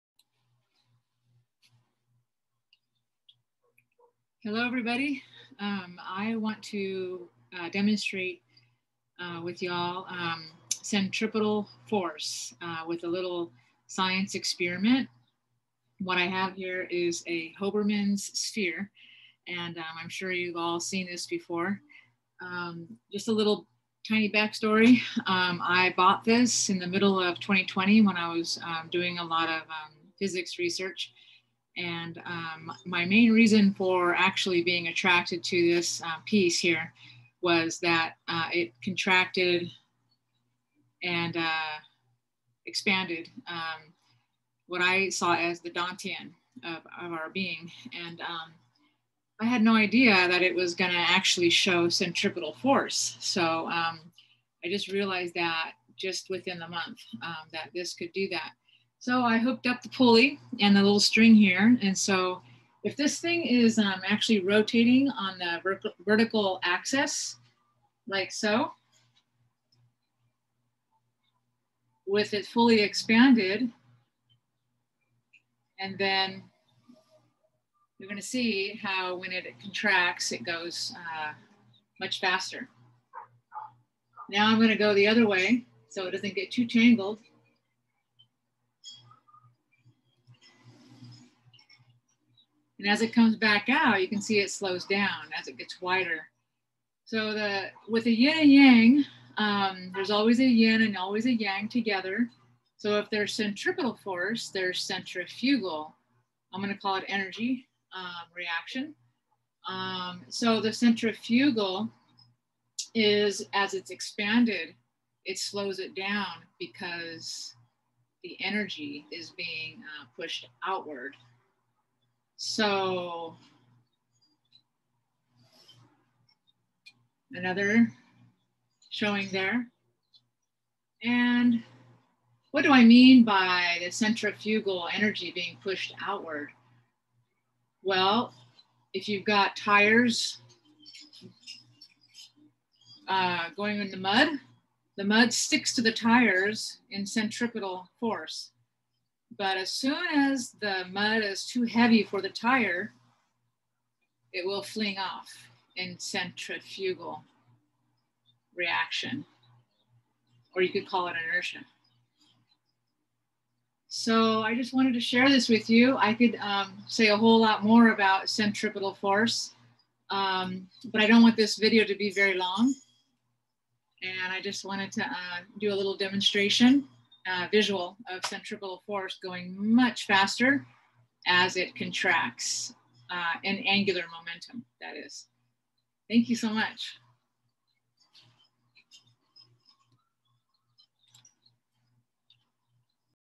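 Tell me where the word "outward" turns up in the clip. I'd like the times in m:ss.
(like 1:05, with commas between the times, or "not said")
2:00, 2:16.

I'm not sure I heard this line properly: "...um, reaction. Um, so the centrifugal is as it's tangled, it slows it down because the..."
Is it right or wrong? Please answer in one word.
wrong.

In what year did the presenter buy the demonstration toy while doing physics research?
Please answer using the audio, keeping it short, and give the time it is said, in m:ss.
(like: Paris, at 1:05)
2020, at 0:27.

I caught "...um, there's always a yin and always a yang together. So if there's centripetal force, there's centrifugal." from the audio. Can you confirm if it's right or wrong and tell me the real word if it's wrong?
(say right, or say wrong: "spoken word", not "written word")
right.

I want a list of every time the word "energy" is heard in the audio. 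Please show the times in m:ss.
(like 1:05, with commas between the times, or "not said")
1:47, 1:58, 2:14.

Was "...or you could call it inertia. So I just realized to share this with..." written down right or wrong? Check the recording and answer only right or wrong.
wrong.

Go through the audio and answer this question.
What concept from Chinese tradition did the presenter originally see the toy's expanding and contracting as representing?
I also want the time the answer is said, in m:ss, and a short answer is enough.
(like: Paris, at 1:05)
Dantian, at 0:45.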